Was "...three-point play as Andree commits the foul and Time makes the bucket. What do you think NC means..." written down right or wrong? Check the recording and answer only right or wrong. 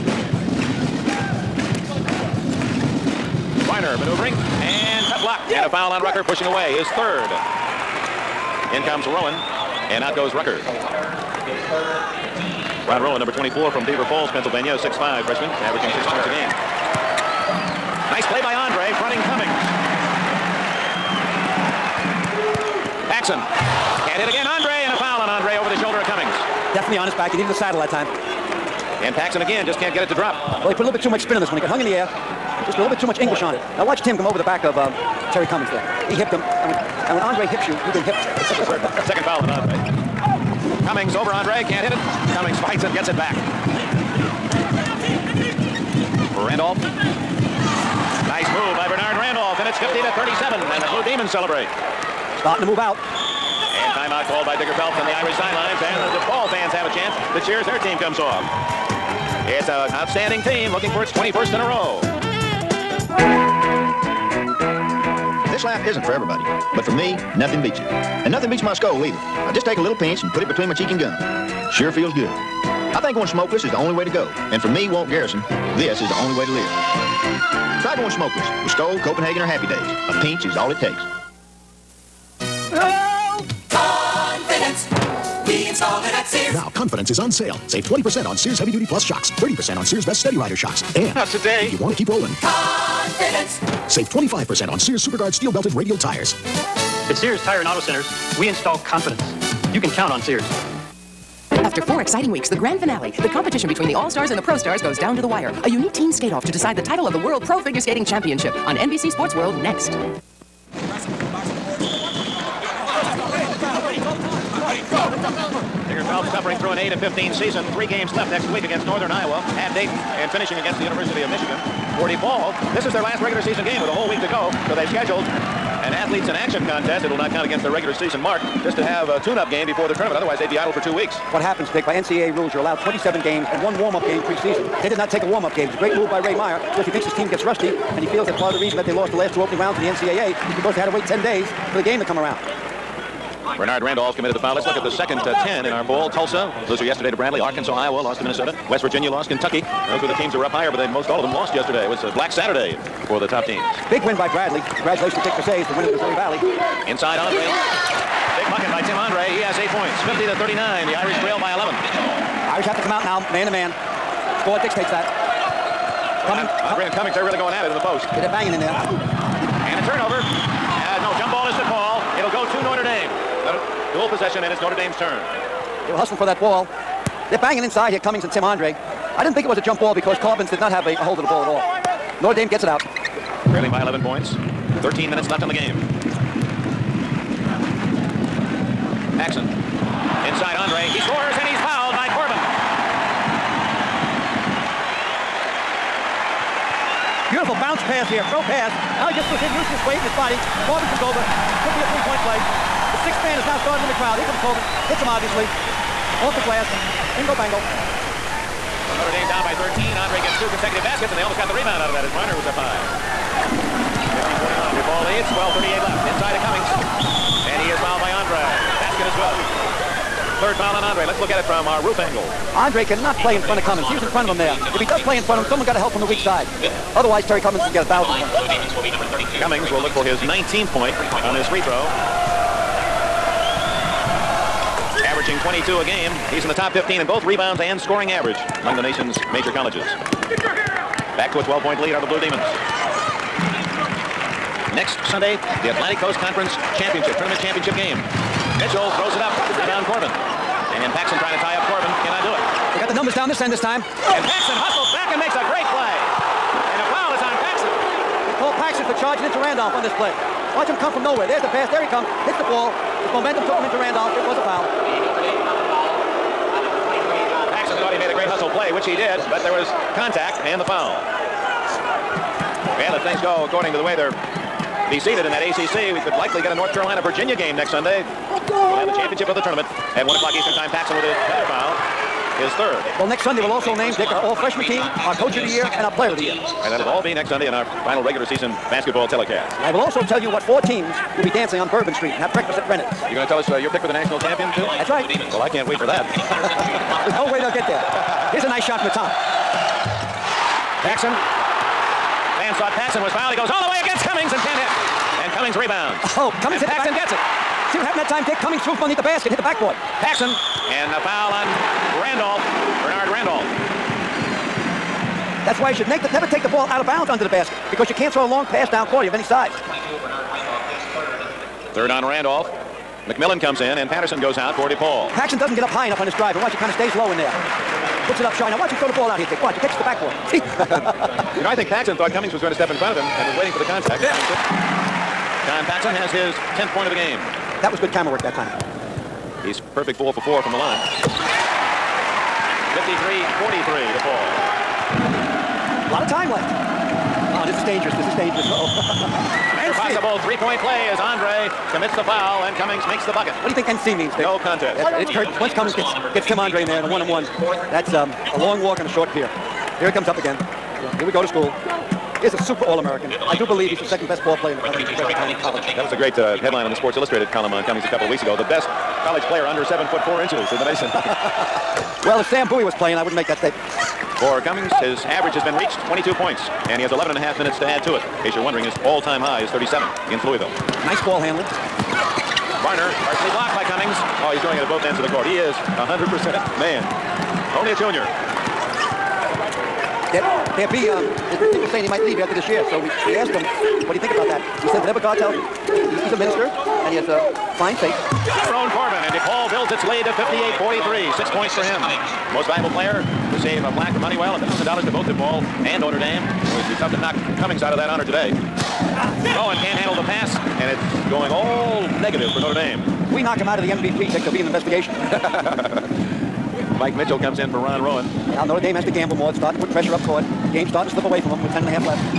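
wrong.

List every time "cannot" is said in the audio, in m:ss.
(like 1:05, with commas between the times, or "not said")
3:42, 4:12.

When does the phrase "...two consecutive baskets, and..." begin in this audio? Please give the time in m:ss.
3:30.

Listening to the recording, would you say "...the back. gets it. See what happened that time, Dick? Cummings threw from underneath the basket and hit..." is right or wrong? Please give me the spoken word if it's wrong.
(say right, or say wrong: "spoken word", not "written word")
right.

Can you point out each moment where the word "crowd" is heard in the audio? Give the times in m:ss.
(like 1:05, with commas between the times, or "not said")
3:23.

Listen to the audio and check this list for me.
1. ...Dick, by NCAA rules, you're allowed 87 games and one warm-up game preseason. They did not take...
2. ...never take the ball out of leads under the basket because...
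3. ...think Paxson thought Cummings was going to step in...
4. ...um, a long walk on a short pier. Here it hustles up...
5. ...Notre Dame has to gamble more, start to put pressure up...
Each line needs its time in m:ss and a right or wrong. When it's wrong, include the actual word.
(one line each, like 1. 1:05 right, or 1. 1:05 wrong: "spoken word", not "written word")
1. 2:11 wrong: "27", not "87"
2. 5:16 wrong: "bounds", not "leads"
3. 5:31 right
4. 5:57 wrong: "comes", not "hustles"
5. 6:58 right.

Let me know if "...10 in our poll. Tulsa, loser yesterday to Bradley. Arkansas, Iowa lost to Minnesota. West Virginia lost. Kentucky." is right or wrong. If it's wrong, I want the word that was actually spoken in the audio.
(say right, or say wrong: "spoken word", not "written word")
right.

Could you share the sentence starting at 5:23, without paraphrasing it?
McMillan comes in and Patterson goes out for DePaul.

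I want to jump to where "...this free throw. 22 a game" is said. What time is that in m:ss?
3:51.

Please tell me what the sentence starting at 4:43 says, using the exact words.
Well, next Sunday we'll also name, Dick, our all-freshman team, our coach of the year, and our player of the year.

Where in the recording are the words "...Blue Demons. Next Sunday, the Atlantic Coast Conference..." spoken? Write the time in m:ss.
4:02.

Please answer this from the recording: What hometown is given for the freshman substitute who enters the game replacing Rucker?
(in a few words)
Beaver Falls, Pennsylvania.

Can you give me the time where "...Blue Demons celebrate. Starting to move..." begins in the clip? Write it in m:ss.
0:50.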